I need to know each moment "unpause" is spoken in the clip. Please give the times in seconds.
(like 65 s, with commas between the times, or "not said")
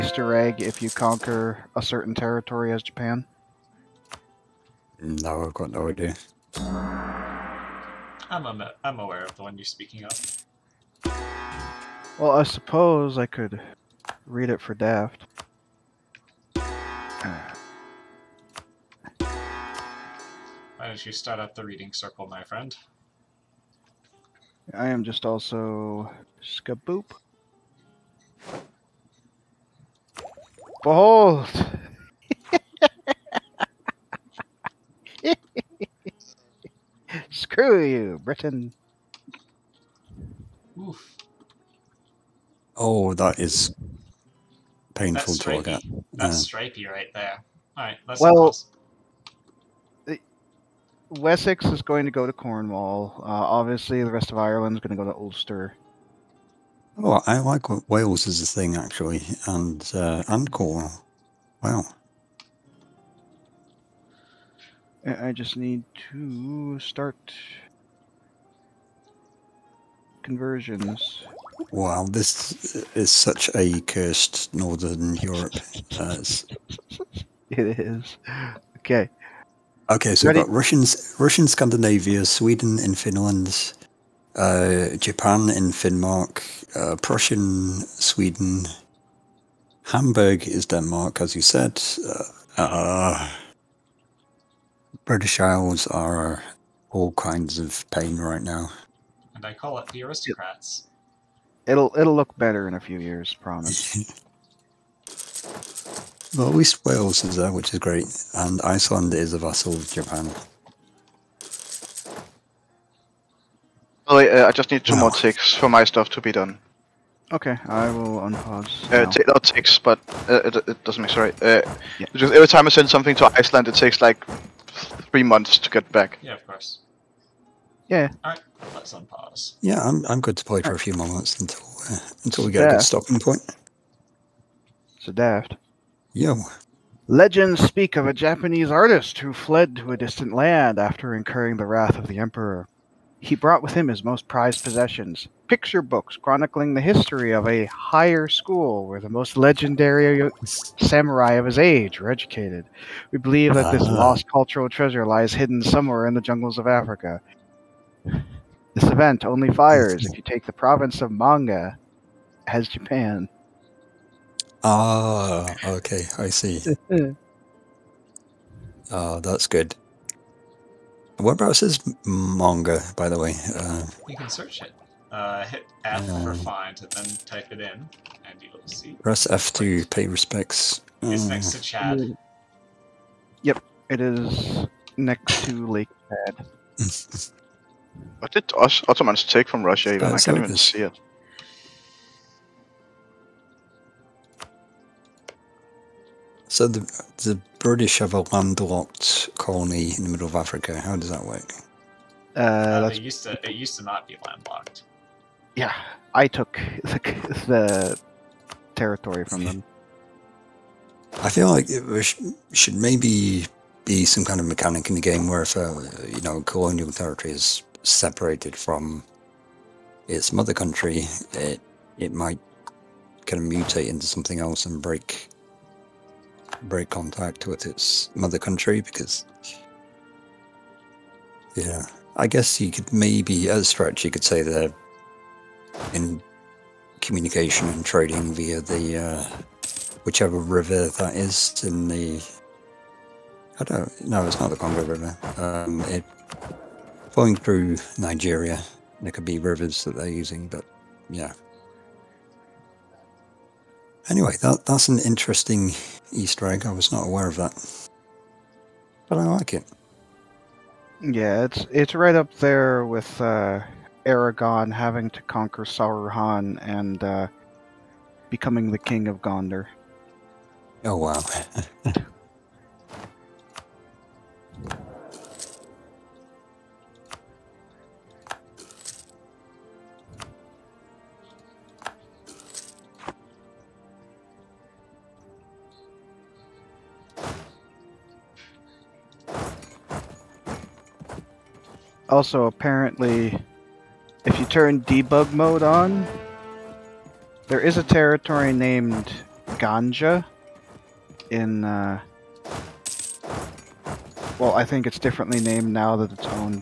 118 s, 128 s.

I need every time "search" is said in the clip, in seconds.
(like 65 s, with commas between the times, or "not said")
174 s.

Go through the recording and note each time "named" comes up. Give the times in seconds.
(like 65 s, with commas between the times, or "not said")
298 s, 305 s.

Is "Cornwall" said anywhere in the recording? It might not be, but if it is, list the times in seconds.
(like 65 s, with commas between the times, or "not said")
52 s, 60 s.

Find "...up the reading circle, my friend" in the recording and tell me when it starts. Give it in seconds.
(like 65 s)
21 s.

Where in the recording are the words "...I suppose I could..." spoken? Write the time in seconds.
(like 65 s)
12 s.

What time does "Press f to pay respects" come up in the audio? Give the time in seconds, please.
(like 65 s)
179 s.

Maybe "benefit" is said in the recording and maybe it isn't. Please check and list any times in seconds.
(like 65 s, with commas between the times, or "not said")
not said.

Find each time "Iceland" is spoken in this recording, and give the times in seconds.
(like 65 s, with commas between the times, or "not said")
108 s, 123 s.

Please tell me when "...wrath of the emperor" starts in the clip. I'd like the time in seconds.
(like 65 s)
141 s.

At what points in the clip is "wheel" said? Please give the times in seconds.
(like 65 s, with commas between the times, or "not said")
not said.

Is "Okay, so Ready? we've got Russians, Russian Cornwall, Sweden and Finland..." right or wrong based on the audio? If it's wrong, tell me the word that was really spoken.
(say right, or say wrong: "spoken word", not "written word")
wrong: "Scandinavia", not "Cornwall".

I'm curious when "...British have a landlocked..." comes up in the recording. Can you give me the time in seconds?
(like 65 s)
197 s.